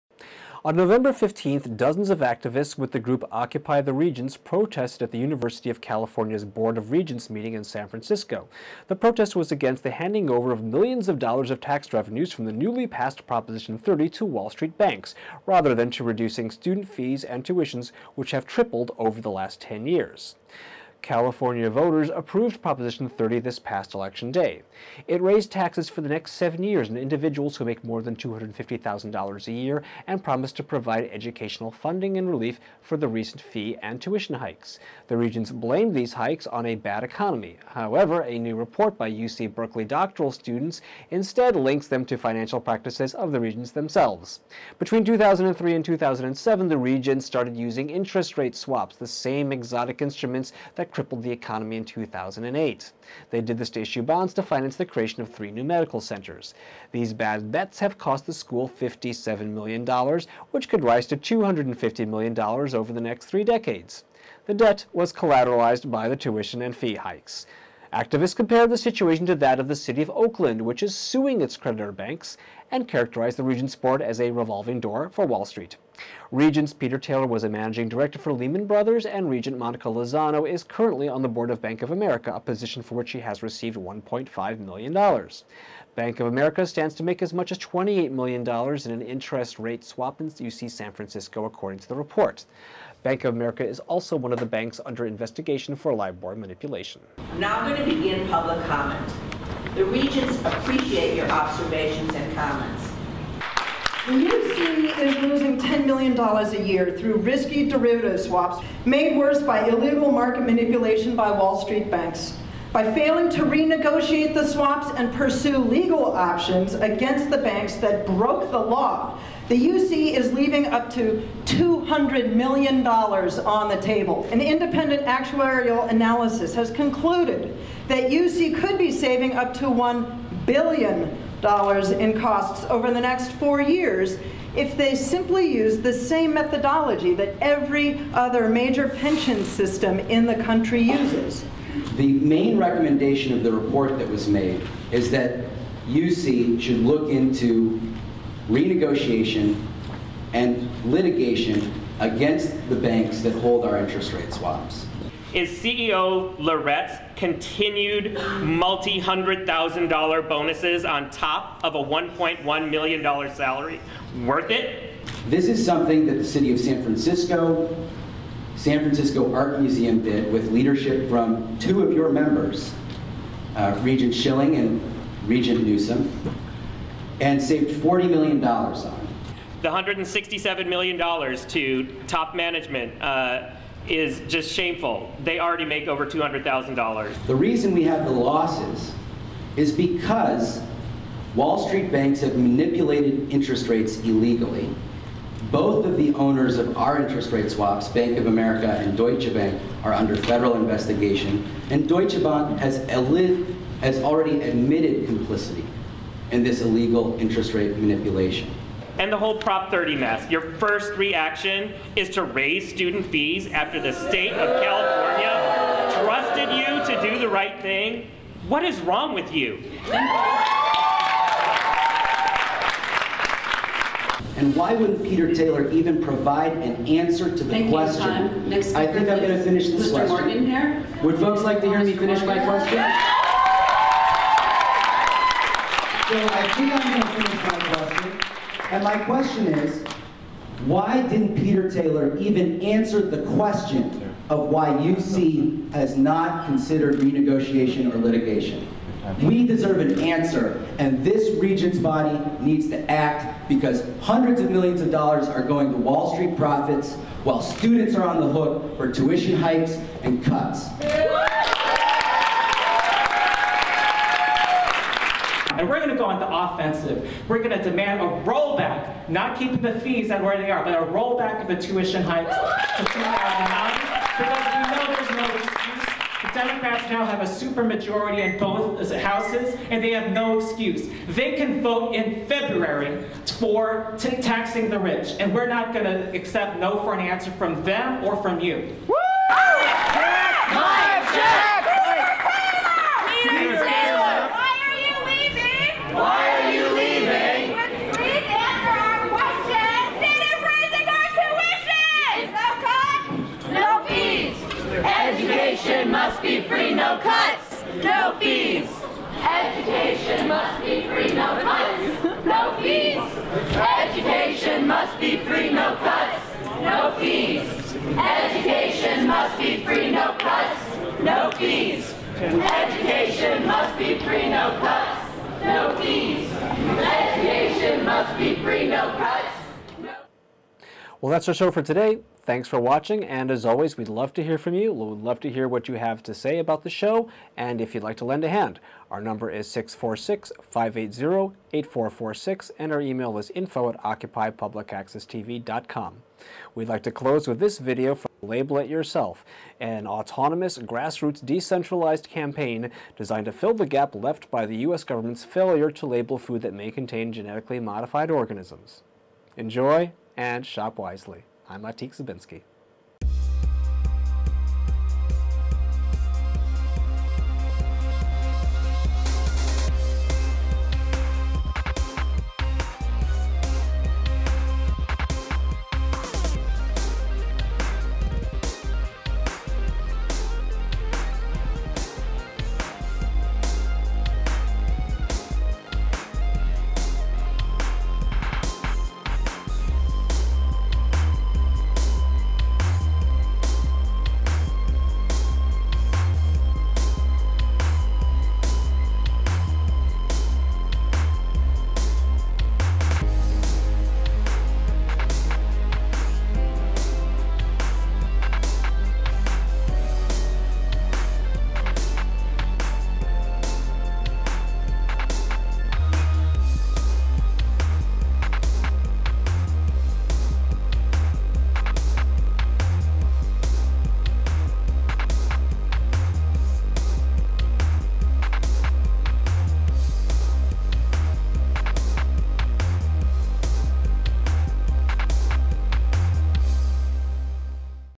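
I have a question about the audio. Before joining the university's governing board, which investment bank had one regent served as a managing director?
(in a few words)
Lehman Brothers.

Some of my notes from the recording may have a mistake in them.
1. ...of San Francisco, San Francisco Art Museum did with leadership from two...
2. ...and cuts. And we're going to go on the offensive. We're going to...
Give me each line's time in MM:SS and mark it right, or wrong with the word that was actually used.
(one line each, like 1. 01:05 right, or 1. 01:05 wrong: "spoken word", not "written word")
1. 02:46 right
2. 04:20 right.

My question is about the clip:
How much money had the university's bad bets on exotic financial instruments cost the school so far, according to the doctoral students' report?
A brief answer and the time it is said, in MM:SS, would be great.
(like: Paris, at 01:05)
$57 million, at 00:58.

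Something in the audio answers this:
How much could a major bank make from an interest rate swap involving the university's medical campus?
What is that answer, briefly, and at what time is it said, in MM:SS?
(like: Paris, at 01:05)
$28 million, at 01:27.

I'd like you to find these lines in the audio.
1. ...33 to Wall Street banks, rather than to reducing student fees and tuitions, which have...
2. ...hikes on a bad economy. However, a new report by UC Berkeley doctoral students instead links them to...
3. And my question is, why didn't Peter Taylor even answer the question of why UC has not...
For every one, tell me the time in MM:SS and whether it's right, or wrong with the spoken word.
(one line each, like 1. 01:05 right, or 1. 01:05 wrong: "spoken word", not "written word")
1. 00:13 wrong: "30", not "33"
2. 00:36 right
3. 03:58 right.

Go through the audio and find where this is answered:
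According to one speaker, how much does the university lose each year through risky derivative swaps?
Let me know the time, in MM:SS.
01:45.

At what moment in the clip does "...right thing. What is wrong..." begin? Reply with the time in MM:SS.
03:37.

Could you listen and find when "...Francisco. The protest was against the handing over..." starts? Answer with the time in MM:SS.
00:07.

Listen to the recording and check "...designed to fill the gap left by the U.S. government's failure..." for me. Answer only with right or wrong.
right.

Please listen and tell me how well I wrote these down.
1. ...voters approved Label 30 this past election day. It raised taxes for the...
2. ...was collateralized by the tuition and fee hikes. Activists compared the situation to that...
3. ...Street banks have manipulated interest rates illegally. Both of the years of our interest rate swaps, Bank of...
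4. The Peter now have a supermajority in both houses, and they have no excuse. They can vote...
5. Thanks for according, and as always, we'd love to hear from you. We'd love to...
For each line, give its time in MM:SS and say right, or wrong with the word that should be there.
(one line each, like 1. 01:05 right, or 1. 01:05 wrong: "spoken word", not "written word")
1. 00:21 wrong: "Proposition", not "Label"
2. 01:04 right
3. 03:11 wrong: "owners", not "years"
4. 04:36 wrong: "Democrats", not "Peter"
5. 05:32 wrong: "watching", not "according".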